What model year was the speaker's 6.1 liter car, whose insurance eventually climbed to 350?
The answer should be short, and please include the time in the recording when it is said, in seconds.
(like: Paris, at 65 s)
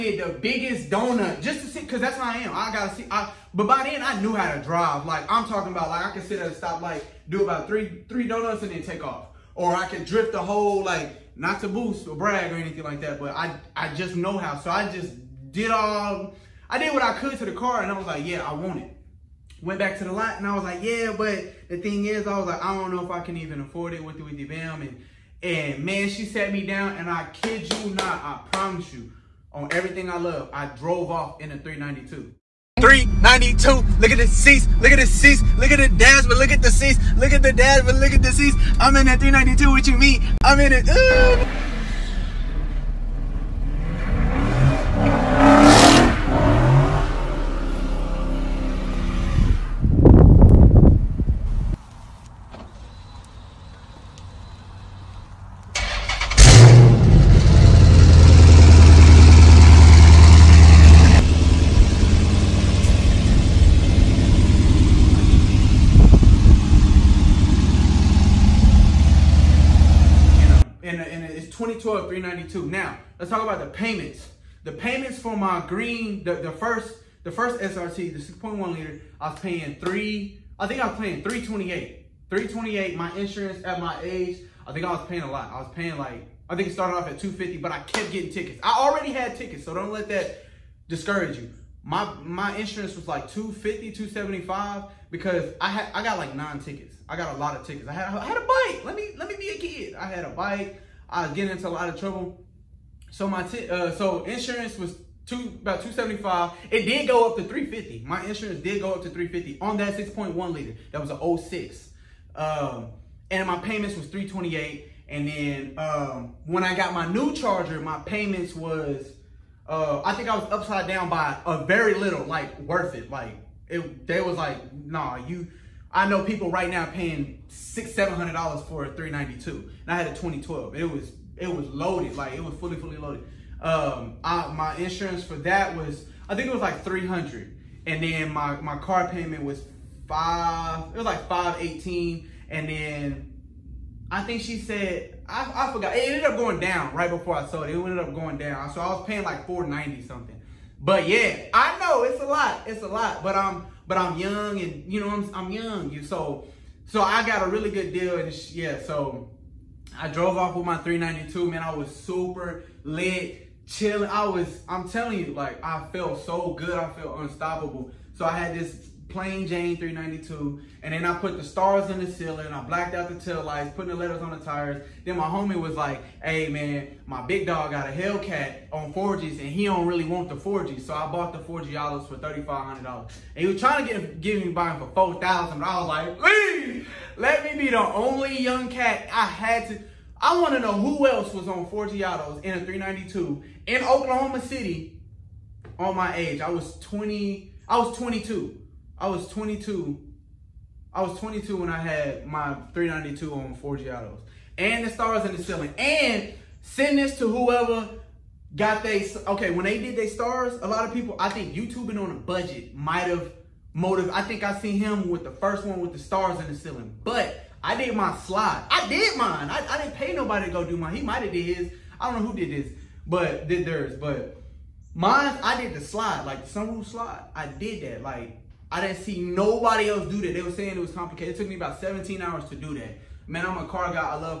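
2006, at 111 s.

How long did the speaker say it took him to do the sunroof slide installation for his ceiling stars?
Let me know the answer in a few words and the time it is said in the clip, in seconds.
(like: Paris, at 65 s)
17 hours, at 231 s.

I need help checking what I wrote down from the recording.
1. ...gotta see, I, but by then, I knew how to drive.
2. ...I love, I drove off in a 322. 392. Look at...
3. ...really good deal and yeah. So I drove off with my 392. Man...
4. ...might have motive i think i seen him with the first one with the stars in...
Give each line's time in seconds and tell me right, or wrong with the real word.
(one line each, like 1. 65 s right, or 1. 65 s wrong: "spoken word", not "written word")
1. 2 s right
2. 30 s wrong: "392", not "322"
3. 157 s right
4. 212 s right.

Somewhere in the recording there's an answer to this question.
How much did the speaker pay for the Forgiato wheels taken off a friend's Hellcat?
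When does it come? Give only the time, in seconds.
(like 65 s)
182 s.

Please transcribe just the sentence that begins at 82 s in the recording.
328, my insurance at my age, I think I was paying a lot.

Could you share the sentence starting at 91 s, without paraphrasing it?
My my insurance was like 250, 275 because I had I got like nine tickets.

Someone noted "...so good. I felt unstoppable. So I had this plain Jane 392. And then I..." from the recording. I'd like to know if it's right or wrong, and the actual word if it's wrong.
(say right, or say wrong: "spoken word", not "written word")
right.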